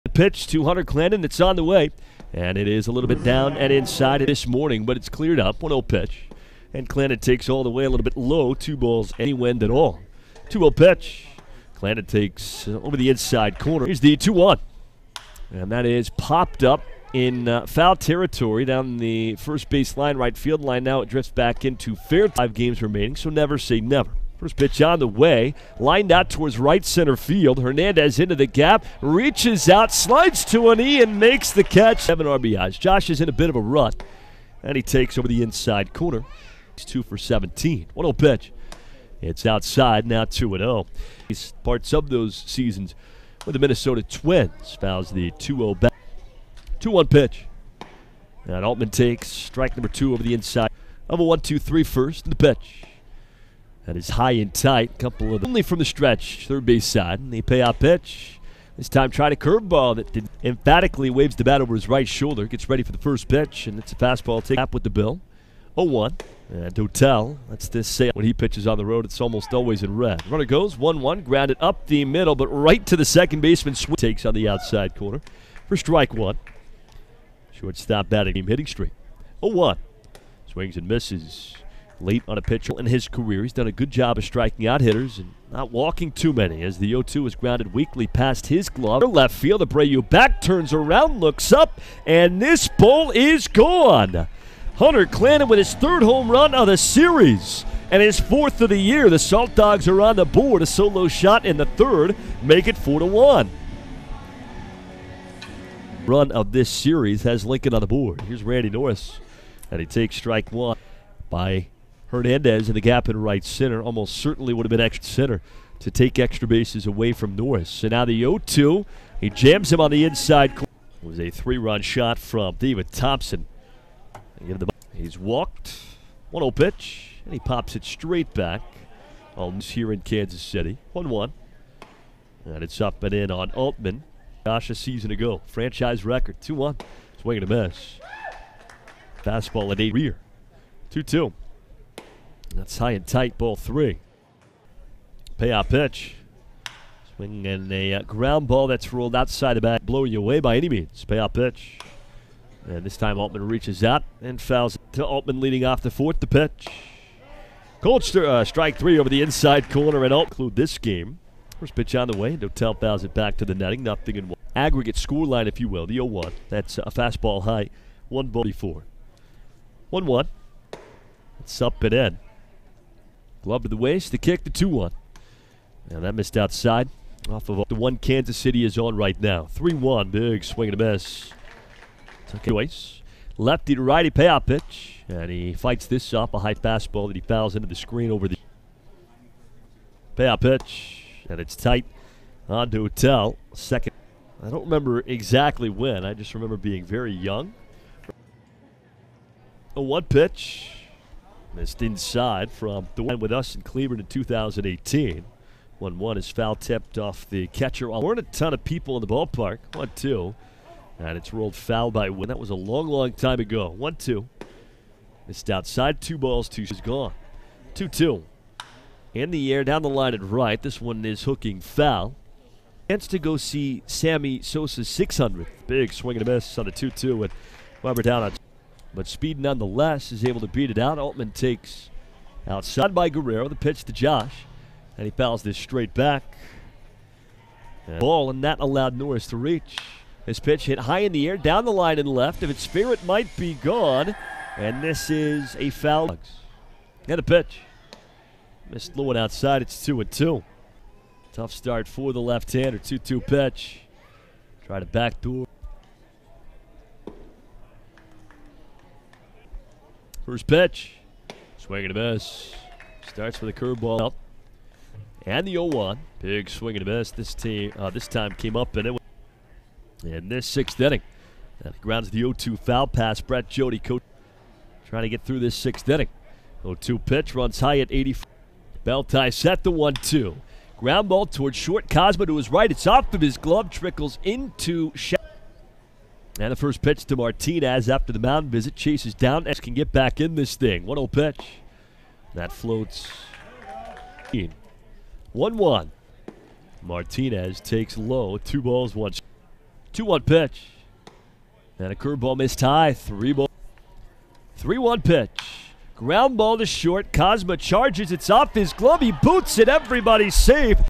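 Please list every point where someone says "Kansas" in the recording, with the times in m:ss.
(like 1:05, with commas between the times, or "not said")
2:10, 2:57.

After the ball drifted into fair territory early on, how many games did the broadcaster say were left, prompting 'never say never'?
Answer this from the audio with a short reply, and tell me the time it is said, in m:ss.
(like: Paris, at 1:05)
5, at 0:22.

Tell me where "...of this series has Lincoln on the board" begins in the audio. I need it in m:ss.
1:46.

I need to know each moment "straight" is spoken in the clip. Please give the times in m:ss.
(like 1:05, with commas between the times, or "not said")
2:07, 3:55.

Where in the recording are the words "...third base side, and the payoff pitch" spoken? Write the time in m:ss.
0:56.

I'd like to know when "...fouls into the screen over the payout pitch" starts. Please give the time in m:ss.
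3:07.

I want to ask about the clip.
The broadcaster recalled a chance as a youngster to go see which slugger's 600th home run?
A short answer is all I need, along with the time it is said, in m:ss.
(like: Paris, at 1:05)
Sammy Sosa, at 3:43.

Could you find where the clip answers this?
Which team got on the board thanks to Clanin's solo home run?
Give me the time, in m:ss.
1:39.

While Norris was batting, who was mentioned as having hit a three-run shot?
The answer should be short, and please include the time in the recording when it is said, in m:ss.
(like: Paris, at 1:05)
David Thompson, at 2:02.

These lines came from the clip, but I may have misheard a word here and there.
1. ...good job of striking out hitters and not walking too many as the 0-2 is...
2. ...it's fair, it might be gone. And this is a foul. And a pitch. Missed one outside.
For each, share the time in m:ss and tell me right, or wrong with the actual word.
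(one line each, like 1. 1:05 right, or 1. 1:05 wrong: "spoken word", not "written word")
1. 1:23 right
2. 4:02 right.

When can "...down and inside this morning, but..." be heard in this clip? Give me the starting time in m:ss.
0:03.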